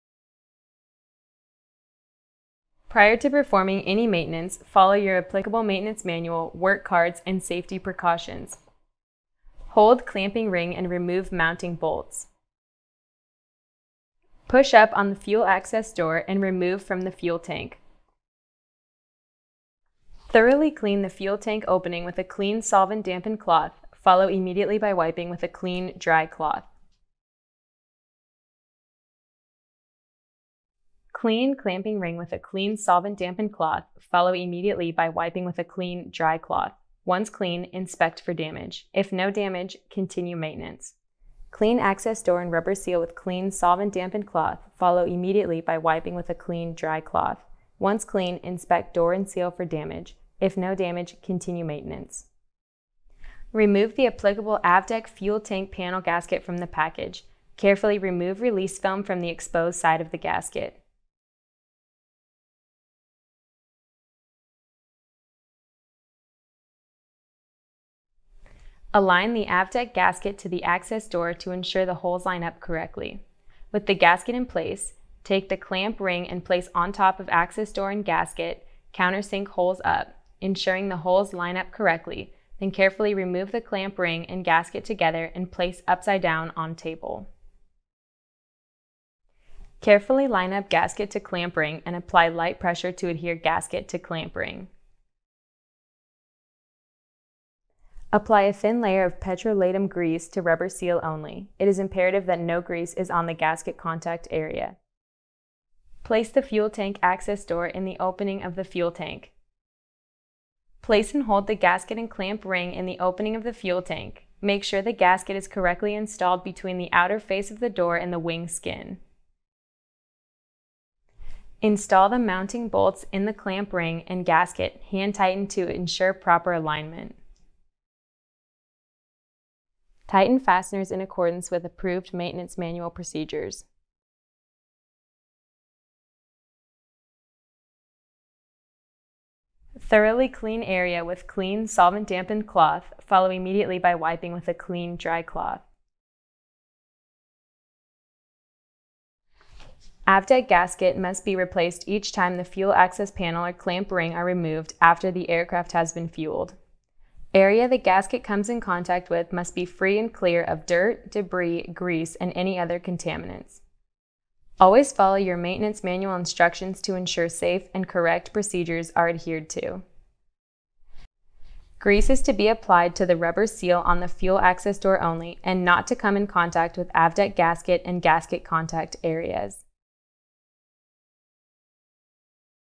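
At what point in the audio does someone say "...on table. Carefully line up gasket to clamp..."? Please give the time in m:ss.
1:26.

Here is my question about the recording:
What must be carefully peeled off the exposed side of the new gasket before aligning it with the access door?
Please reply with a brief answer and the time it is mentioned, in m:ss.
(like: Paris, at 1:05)
Release film, at 0:58.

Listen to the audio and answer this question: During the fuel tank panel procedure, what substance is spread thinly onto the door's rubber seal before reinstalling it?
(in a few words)
Petrolatum grease.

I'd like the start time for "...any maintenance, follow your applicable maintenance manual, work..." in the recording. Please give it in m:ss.
0:03.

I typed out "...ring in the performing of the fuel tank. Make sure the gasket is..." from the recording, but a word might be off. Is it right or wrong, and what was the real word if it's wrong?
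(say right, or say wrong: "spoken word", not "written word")
wrong: "opening", not "performing".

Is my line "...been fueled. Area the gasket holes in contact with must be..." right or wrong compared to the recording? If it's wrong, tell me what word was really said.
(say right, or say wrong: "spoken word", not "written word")
wrong: "comes", not "holes".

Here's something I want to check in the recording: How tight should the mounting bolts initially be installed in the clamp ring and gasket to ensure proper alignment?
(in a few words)
Hand tightened.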